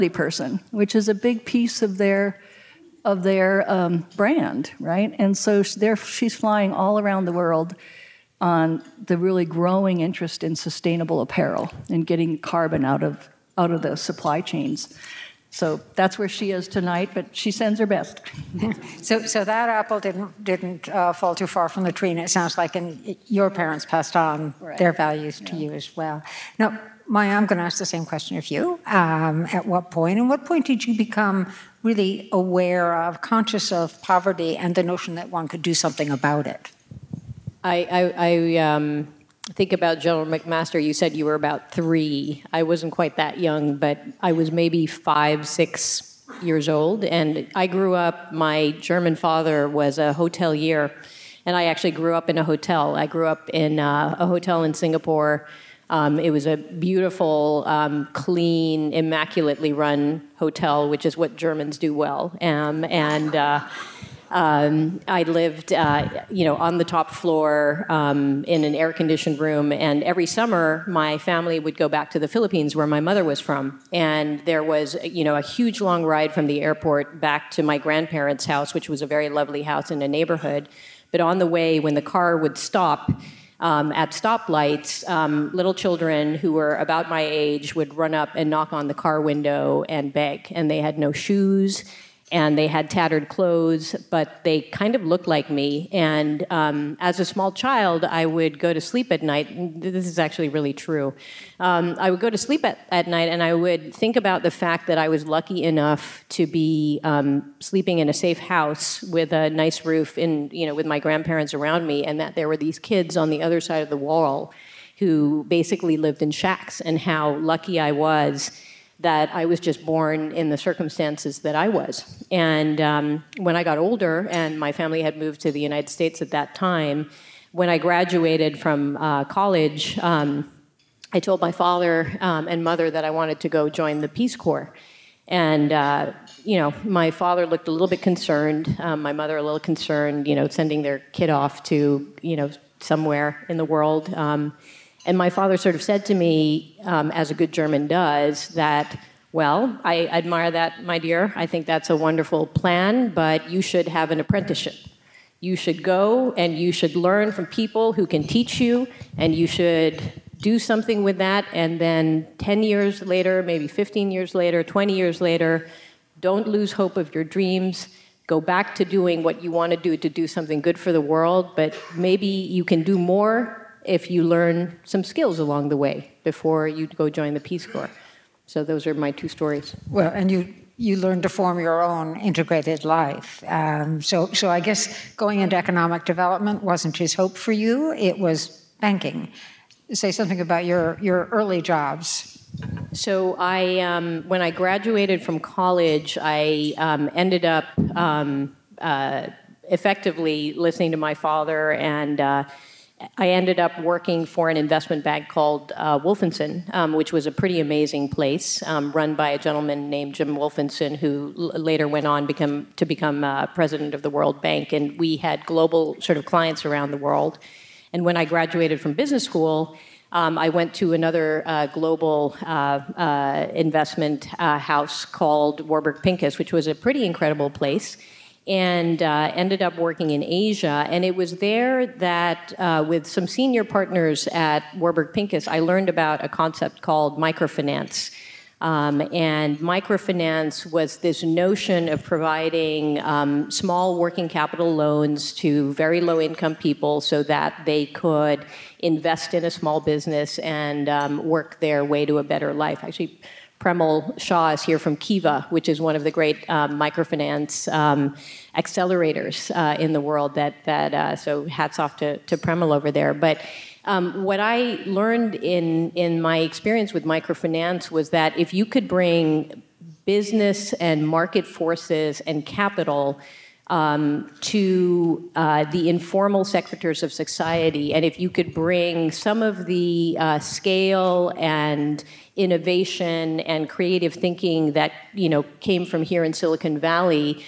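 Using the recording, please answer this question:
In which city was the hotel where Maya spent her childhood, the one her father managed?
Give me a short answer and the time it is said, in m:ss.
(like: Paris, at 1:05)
Singapore, at 0:54.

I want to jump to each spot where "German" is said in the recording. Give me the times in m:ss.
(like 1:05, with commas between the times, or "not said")
0:48, 1:01, 2:27.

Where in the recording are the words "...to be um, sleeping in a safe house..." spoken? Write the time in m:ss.
1:46.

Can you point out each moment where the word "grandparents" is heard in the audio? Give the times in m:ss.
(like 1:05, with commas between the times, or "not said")
1:17, 1:51.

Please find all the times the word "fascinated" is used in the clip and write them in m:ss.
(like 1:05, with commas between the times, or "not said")
not said.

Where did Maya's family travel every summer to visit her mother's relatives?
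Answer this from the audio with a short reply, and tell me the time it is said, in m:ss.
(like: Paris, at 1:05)
the Philippines, at 1:12.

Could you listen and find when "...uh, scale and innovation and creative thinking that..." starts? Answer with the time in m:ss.
4:40.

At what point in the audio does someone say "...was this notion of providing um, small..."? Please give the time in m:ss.
4:00.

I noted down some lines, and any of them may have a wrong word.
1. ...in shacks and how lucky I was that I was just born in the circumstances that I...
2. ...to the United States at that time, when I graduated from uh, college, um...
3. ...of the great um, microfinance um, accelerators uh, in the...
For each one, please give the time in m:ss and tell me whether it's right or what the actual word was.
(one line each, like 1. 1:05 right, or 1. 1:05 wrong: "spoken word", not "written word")
1. 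1:56 right
2. 2:05 right
3. 4:15 right.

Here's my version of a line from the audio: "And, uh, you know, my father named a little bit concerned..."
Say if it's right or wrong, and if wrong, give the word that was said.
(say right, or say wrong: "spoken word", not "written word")
wrong: "looked", not "named".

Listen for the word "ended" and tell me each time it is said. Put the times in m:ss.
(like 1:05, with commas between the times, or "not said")
3:17, 3:23, 3:49.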